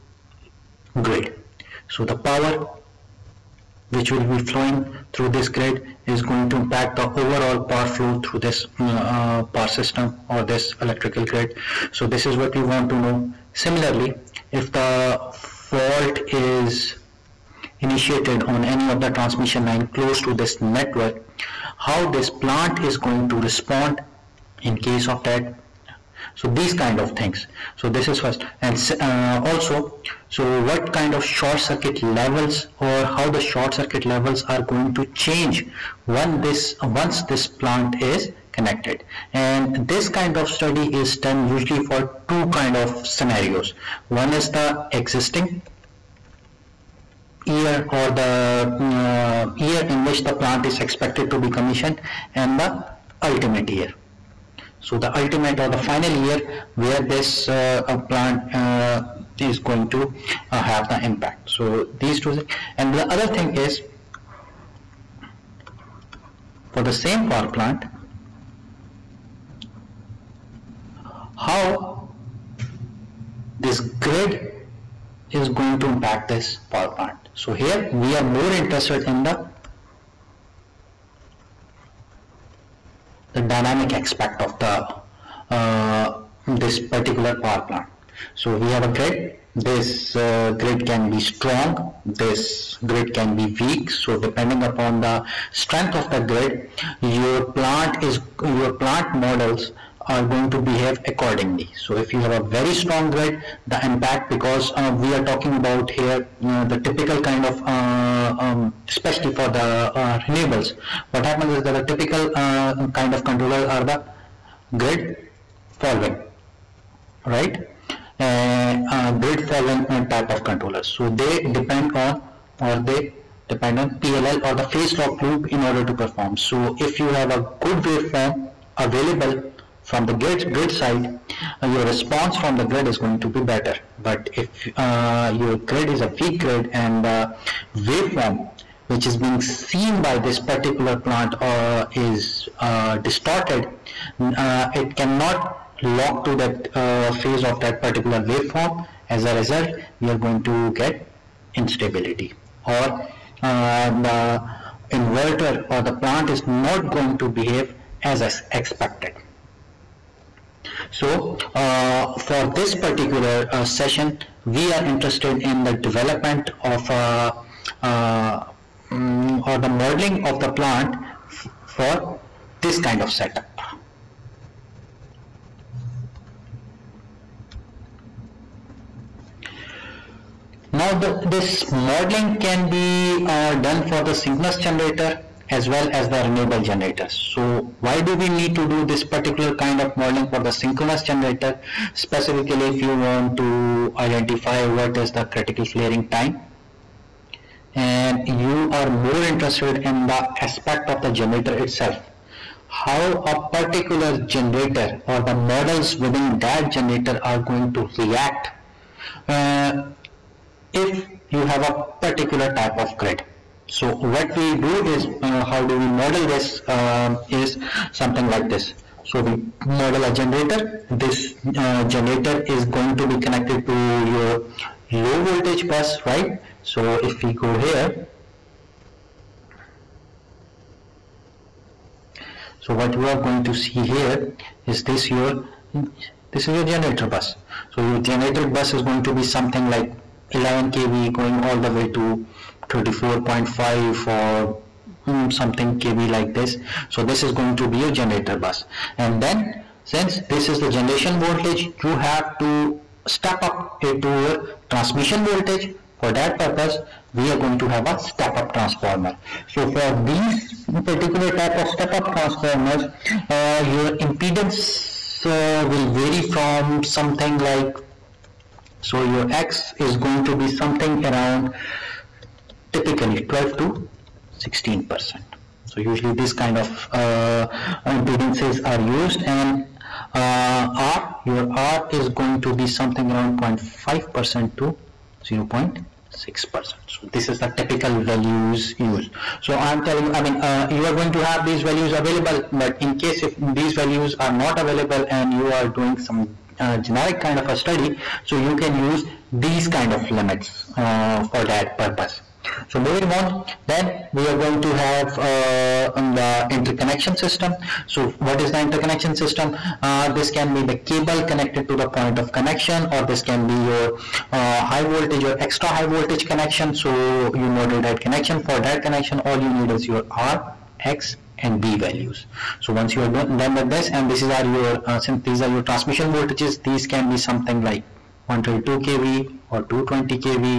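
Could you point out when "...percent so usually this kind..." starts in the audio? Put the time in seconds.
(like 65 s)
274 s.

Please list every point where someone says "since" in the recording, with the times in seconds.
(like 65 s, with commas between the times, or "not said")
249 s, 325 s.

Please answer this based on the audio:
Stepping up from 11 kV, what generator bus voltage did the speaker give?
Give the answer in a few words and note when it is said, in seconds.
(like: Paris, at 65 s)
34.5 kV, at 242 s.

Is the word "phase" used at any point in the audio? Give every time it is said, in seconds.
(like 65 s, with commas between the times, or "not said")
124 s, 147 s.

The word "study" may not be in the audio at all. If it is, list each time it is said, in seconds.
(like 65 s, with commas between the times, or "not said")
40 s, 297 s.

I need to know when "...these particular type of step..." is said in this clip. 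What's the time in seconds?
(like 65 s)
260 s.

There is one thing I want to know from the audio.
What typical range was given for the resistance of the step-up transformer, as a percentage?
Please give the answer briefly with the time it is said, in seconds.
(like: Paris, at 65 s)
0.5 to 0.6 percent, at 283 s.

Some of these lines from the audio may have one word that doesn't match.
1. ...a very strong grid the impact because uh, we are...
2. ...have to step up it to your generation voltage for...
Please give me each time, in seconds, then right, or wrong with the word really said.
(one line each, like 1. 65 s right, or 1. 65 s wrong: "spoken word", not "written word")
1. 102 s right
2. 251 s wrong: "transmission", not "generation".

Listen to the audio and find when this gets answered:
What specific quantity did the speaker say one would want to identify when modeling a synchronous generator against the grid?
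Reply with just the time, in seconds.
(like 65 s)
195 s.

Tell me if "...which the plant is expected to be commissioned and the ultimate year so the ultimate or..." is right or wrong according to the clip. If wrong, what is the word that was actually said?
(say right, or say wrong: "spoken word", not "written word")
right.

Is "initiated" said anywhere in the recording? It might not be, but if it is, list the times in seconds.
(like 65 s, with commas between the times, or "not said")
17 s.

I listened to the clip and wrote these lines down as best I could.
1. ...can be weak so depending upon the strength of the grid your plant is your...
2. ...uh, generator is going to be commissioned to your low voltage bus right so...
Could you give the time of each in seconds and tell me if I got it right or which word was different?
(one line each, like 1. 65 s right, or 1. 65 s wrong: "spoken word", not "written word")
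1. 93 s right
2. 221 s wrong: "connected", not "commissioned".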